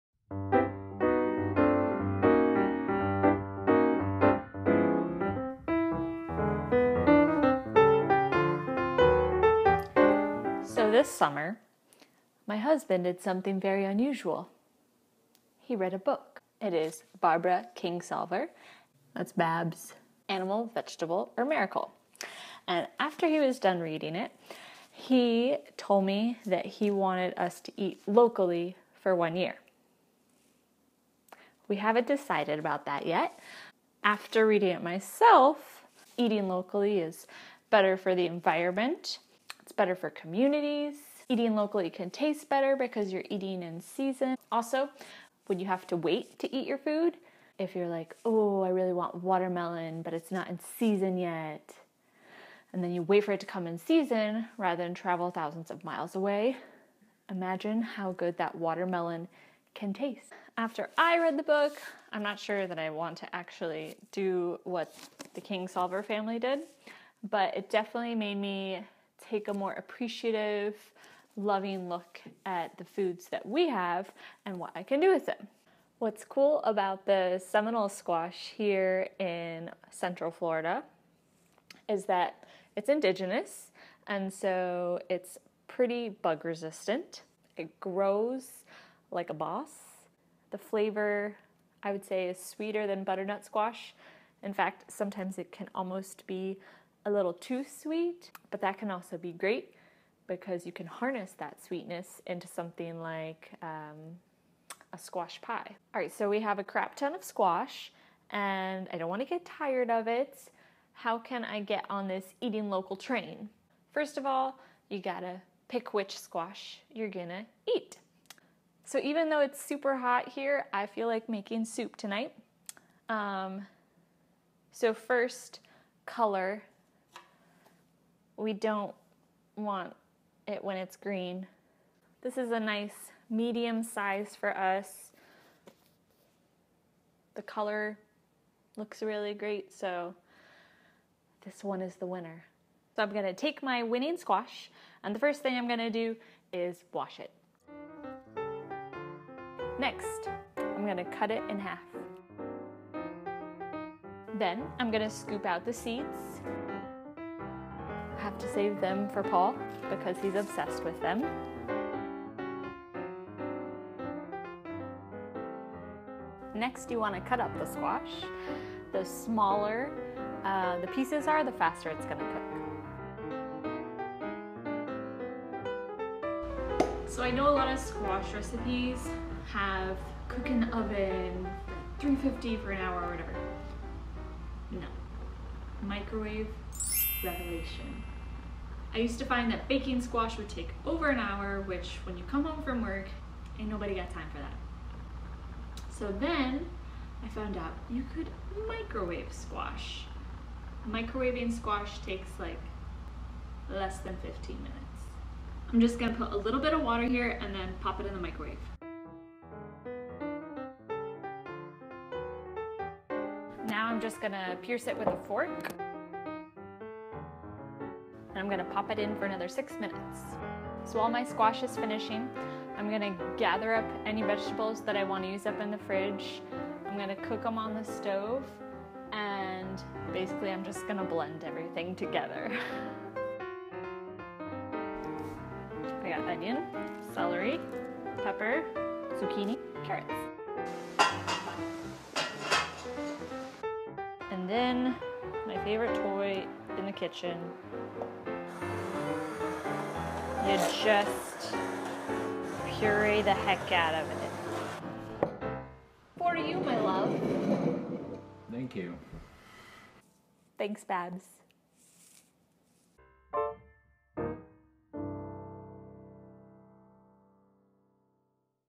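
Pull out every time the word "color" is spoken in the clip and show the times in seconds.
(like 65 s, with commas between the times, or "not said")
126 s, 137 s.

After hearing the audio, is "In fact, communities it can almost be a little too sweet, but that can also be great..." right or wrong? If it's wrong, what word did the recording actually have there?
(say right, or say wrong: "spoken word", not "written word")
wrong: "sometimes", not "communities".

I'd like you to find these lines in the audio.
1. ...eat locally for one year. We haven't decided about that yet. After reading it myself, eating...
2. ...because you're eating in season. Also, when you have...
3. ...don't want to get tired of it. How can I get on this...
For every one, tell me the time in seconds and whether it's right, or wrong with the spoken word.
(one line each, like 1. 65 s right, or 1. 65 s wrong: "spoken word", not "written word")
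1. 27 s right
2. 42 s right
3. 108 s right.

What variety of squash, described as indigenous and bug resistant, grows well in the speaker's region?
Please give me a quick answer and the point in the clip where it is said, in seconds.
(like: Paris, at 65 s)
Seminole squash, at 77 s.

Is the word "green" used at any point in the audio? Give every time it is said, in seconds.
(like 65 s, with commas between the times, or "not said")
130 s.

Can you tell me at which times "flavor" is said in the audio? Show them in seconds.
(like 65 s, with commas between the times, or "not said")
90 s.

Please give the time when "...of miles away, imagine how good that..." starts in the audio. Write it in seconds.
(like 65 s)
55 s.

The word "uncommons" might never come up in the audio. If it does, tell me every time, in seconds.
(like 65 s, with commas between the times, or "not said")
not said.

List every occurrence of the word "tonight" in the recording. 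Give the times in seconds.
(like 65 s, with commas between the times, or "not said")
121 s.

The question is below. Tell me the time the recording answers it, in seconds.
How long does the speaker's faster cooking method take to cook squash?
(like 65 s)
203 s.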